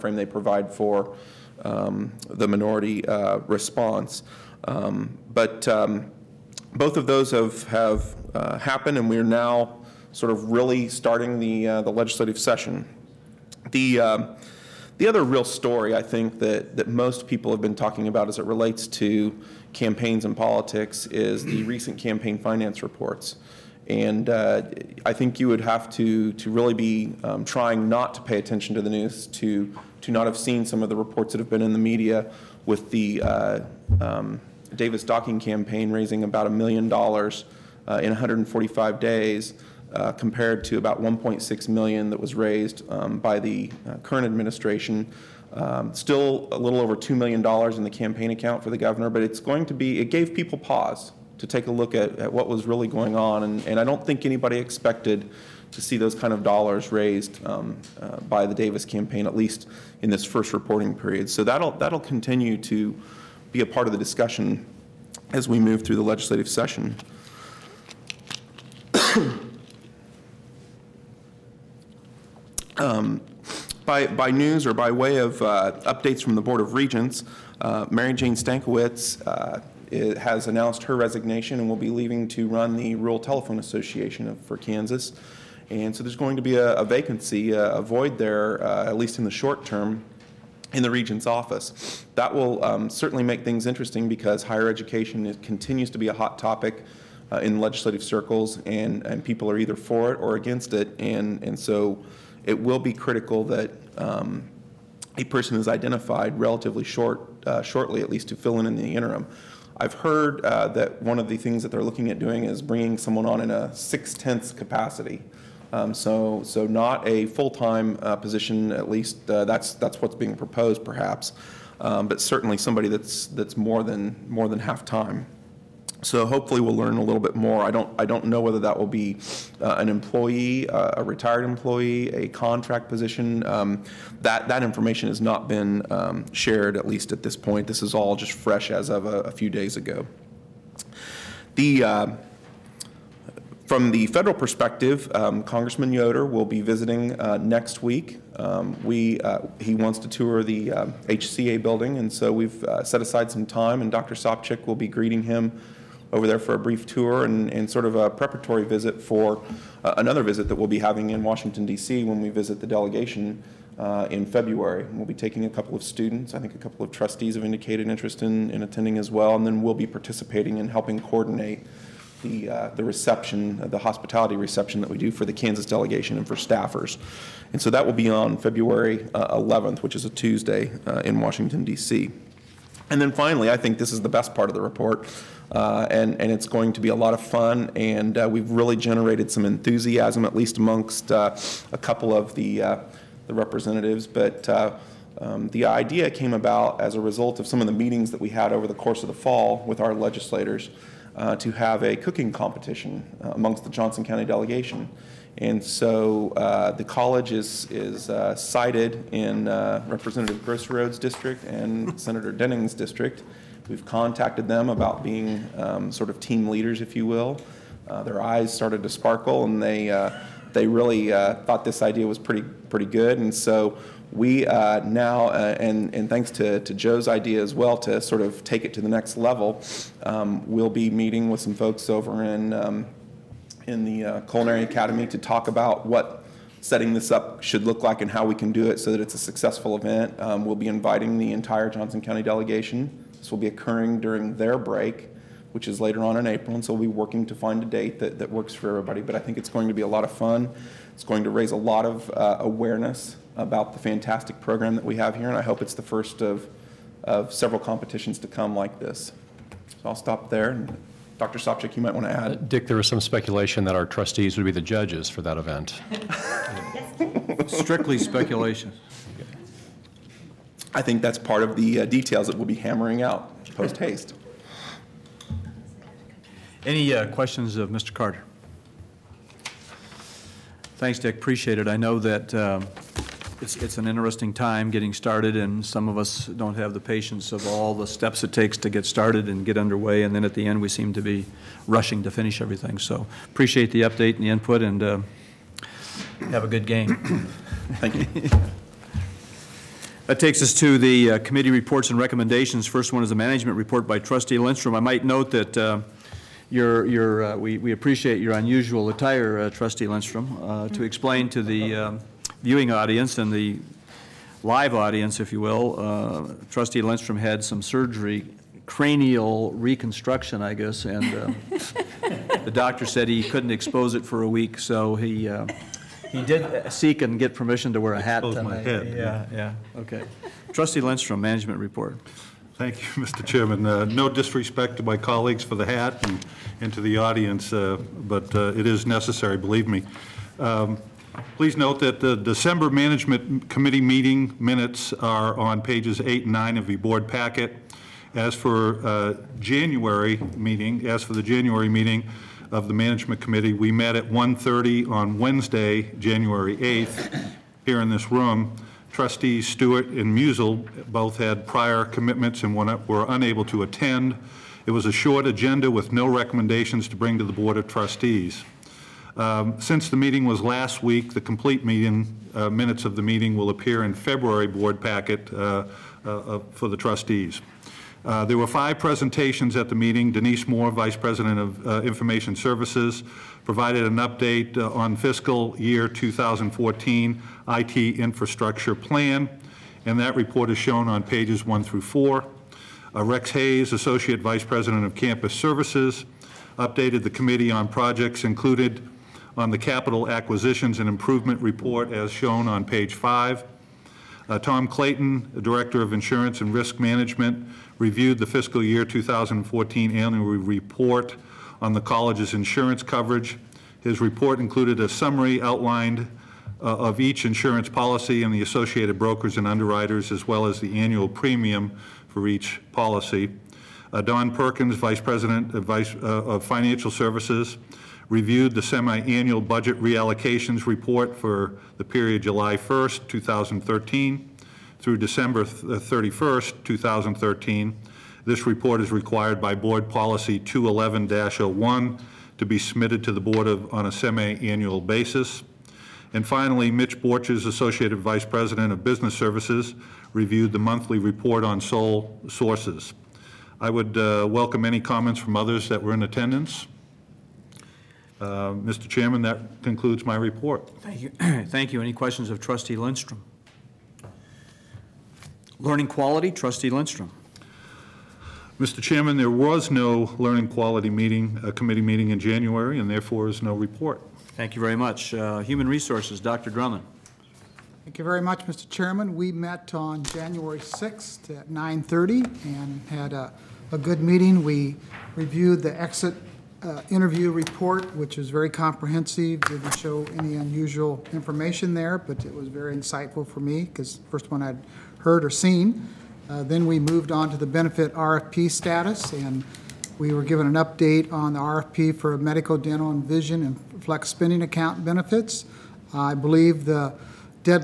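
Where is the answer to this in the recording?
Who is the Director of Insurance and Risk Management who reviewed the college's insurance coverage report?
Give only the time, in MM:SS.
06:44.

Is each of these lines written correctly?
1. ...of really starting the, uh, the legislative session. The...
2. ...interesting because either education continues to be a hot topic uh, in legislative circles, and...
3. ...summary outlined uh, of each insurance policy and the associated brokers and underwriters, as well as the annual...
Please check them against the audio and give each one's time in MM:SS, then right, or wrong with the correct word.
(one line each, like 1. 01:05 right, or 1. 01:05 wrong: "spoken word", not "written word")
1. 00:10 right
2. 01:33 wrong: "higher", not "either"
3. 06:54 right.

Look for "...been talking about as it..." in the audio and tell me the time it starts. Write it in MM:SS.
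00:17.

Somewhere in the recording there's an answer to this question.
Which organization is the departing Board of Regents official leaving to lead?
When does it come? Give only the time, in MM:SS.
01:22.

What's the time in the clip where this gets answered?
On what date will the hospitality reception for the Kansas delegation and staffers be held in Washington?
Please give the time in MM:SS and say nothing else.
02:58.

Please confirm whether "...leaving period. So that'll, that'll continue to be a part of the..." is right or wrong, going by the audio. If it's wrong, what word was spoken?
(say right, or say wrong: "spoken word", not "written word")
wrong: "reporting", not "leaving".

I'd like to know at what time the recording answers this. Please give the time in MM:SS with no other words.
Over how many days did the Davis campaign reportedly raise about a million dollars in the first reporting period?
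00:38.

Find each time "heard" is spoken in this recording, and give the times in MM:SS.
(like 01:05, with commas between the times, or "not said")
01:49, 08:14.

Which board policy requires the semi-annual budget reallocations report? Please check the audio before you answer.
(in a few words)
211-01.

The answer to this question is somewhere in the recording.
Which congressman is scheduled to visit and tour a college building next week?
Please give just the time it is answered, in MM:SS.
02:25.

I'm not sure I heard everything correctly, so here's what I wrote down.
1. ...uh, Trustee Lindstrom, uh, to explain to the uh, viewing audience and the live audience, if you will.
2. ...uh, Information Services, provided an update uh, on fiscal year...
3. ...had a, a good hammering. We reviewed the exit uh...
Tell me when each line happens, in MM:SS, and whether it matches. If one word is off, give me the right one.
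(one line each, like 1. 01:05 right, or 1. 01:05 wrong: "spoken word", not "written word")
1. 05:09 right
2. 06:21 right
3. 08:02 wrong: "meeting", not "hammering".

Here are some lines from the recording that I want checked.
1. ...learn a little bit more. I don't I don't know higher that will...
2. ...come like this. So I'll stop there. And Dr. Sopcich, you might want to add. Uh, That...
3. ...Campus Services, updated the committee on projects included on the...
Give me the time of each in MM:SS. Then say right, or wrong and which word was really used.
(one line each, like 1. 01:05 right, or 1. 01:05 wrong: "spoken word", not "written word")
1. 02:06 wrong: "whether", not "higher"
2. 04:18 wrong: "Dick", not "That"
3. 06:34 right.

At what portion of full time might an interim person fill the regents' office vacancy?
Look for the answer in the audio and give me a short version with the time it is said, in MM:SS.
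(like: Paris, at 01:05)
six-tenths, at 01:53.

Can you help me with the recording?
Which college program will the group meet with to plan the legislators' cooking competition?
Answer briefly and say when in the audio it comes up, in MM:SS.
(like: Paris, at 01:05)
Culinary Academy, at 03:54.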